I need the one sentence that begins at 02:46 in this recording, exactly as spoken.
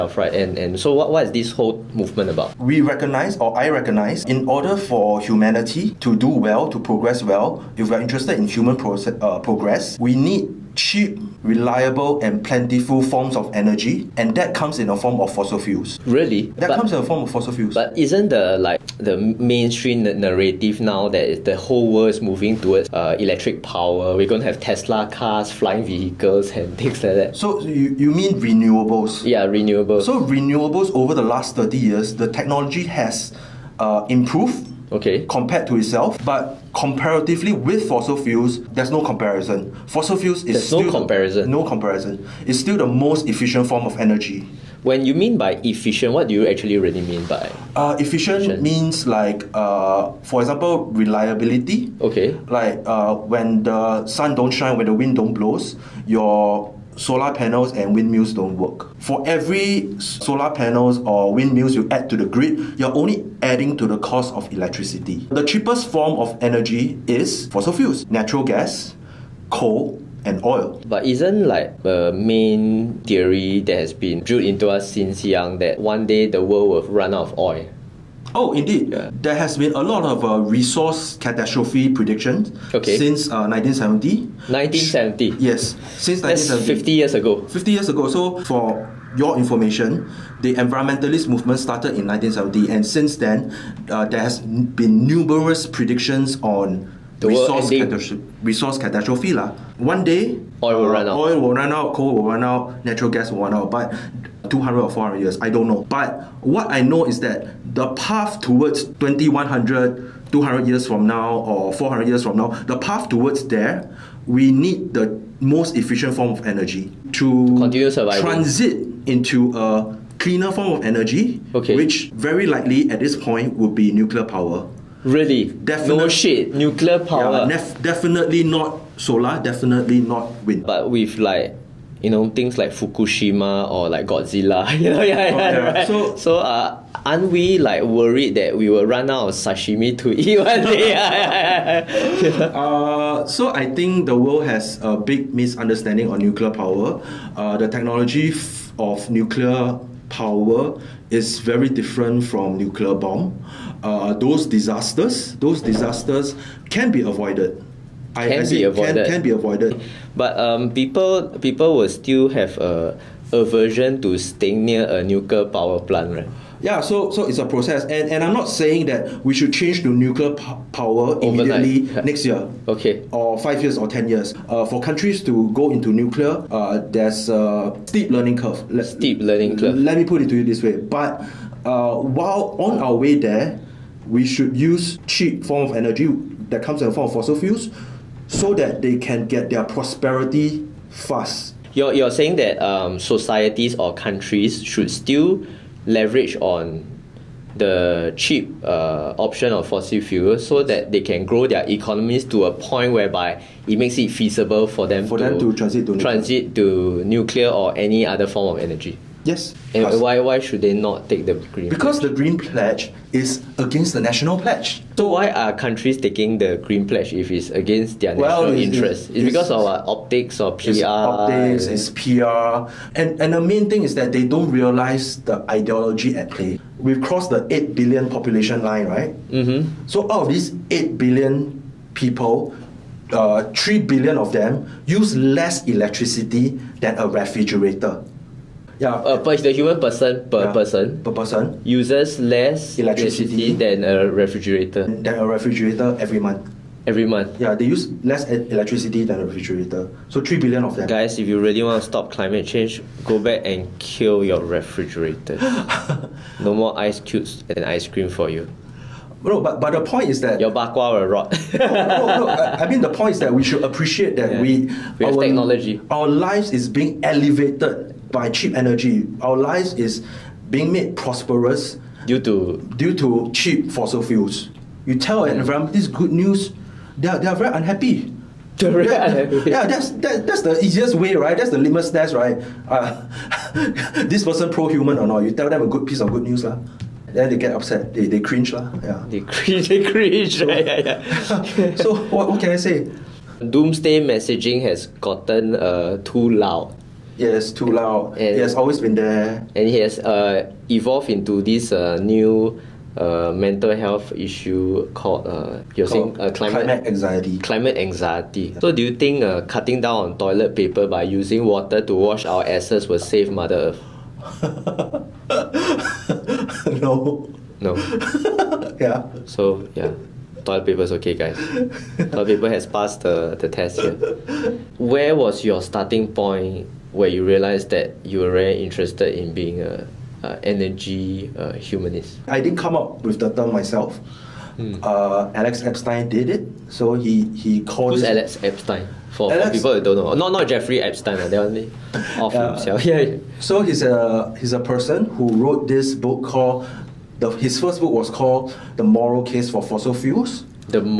Yeah, so so it's a process, and and I'm not saying that we should change to nuclear power immediately Overnight.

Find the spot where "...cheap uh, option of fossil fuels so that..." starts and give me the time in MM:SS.
03:18.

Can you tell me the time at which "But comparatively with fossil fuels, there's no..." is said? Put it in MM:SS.
00:36.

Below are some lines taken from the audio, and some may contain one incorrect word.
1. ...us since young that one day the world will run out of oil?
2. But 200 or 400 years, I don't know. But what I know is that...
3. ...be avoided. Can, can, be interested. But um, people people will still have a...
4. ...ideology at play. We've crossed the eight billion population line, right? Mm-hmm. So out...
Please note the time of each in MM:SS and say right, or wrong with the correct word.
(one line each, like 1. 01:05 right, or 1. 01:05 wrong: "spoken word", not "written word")
1. 01:14 right
2. 01:43 right
3. 02:38 wrong: "avoided", not "interested"
4. 03:45 right.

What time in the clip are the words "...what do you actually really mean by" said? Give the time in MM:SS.
00:46.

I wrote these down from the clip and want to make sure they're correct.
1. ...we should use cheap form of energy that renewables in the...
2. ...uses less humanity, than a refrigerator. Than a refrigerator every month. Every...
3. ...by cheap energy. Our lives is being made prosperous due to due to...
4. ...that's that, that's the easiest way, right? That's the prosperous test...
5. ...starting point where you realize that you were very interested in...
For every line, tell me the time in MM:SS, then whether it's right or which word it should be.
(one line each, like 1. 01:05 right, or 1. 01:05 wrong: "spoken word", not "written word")
1. 03:04 wrong: "comes", not "renewables"
2. 04:01 wrong: "electricity", not "humanity"
3. 04:28 right
4. 04:39 wrong: "litmus", not "prosperous"
5. 05:25 right.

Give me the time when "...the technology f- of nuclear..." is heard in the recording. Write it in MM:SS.
02:27.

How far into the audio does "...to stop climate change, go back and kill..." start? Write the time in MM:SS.
04:11.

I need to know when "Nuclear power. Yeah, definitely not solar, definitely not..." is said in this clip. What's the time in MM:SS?
02:06.